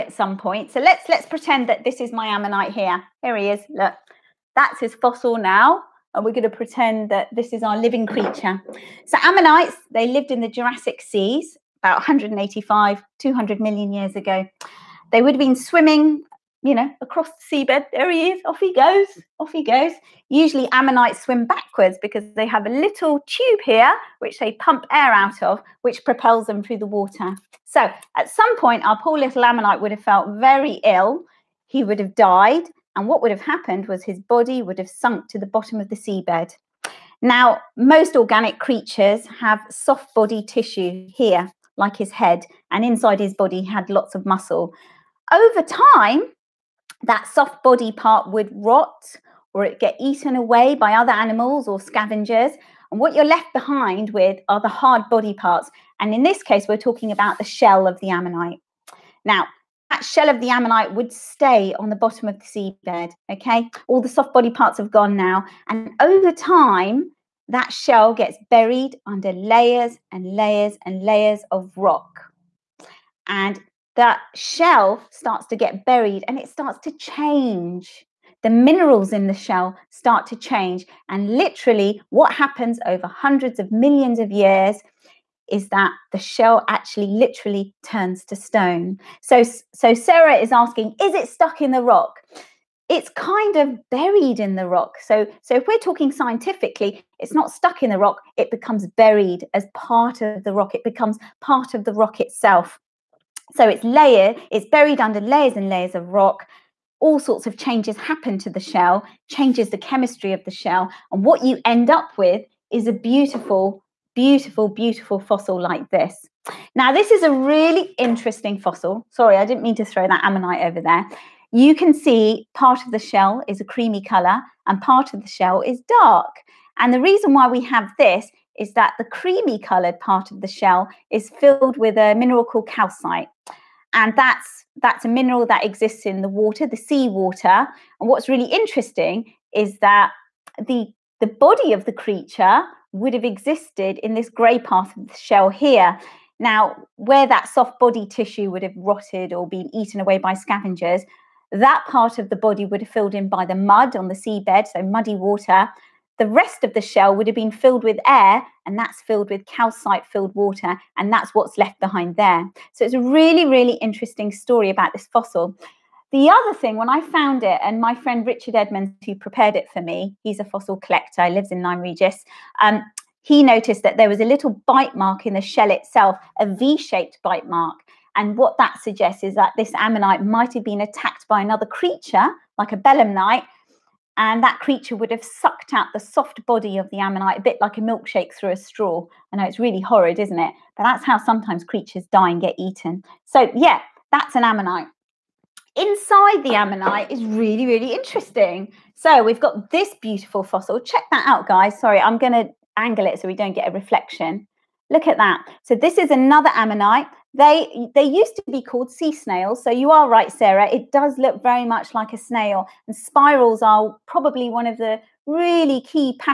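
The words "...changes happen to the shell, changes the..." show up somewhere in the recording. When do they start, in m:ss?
1:47.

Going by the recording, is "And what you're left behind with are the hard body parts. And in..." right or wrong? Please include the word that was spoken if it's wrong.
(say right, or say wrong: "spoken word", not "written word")
right.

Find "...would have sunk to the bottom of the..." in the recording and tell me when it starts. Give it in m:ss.
0:34.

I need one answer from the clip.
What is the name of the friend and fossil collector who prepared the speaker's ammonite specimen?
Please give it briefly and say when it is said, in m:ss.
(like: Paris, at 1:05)
Richard Edmonds, at 2:48.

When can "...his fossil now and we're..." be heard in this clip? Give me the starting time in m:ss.
0:04.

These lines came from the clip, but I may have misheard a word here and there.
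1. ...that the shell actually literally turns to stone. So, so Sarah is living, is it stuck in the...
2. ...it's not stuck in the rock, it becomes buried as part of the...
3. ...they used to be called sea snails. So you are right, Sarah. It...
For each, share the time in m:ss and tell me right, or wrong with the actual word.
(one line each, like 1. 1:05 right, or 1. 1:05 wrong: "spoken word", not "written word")
1. 1:25 wrong: "asking", not "living"
2. 1:37 right
3. 3:27 right.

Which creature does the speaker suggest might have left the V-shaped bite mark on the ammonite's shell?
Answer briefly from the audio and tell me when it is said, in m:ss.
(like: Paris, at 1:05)
a belemnite, at 3:02.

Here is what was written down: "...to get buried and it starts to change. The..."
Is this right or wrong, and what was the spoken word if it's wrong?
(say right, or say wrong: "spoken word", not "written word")
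right.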